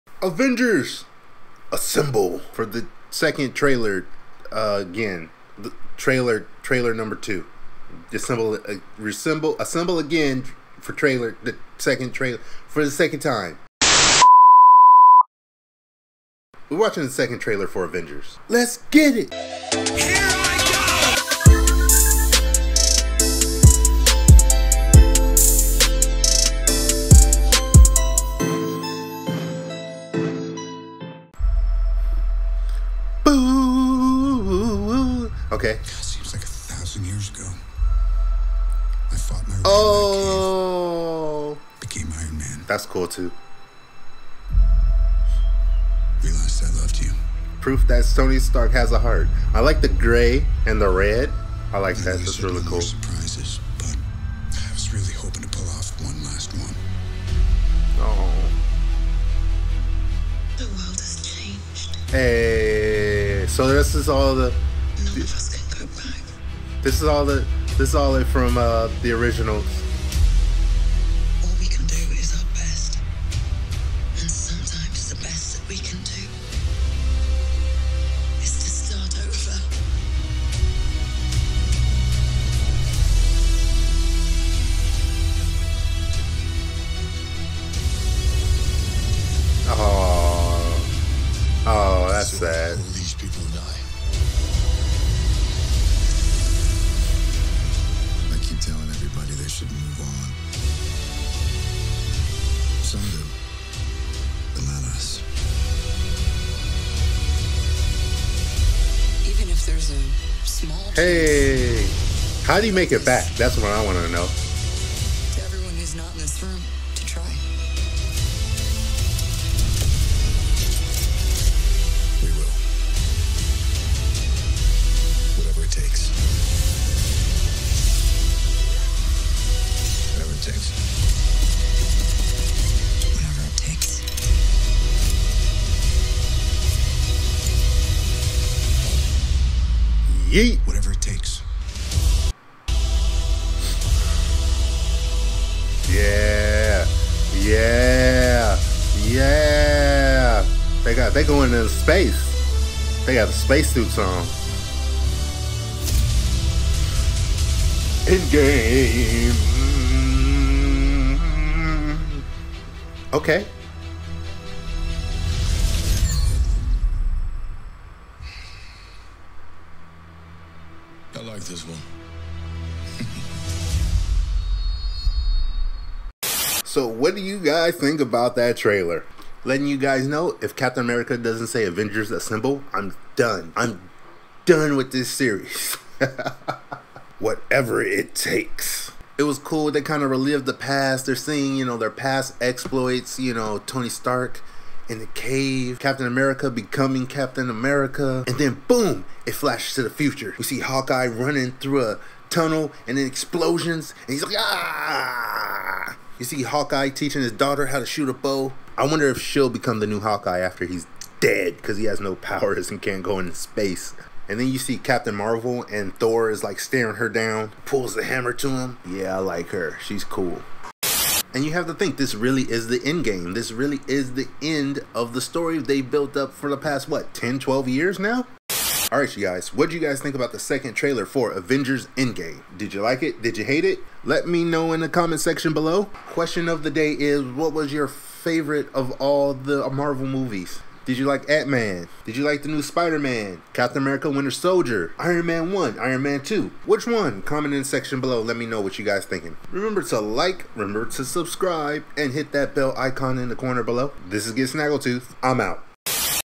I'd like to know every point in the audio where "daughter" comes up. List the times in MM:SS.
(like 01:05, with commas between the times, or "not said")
03:27.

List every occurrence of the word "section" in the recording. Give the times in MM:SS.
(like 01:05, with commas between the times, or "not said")
03:55, 04:07.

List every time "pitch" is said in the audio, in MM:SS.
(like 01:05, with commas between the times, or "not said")
not said.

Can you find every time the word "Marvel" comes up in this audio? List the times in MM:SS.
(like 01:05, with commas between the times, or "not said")
03:35, 03:59.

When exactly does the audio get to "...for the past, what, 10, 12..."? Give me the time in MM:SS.
03:46.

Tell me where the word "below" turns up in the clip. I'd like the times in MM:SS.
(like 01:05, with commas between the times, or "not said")
03:55, 04:08, 04:13.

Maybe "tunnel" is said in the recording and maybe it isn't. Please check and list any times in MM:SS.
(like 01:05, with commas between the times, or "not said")
03:22.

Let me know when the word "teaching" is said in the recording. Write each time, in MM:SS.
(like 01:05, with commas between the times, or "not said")
03:26.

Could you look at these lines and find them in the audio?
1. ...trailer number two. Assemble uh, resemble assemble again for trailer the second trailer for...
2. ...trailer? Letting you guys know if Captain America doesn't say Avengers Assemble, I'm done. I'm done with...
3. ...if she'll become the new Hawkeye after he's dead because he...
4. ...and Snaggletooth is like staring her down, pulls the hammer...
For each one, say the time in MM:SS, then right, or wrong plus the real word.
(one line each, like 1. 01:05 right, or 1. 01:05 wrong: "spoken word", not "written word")
1. 00:06 right
2. 02:58 right
3. 03:29 right
4. 03:35 wrong: "Thor", not "Snaggletooth".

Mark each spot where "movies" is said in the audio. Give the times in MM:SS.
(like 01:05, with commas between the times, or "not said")
04:00.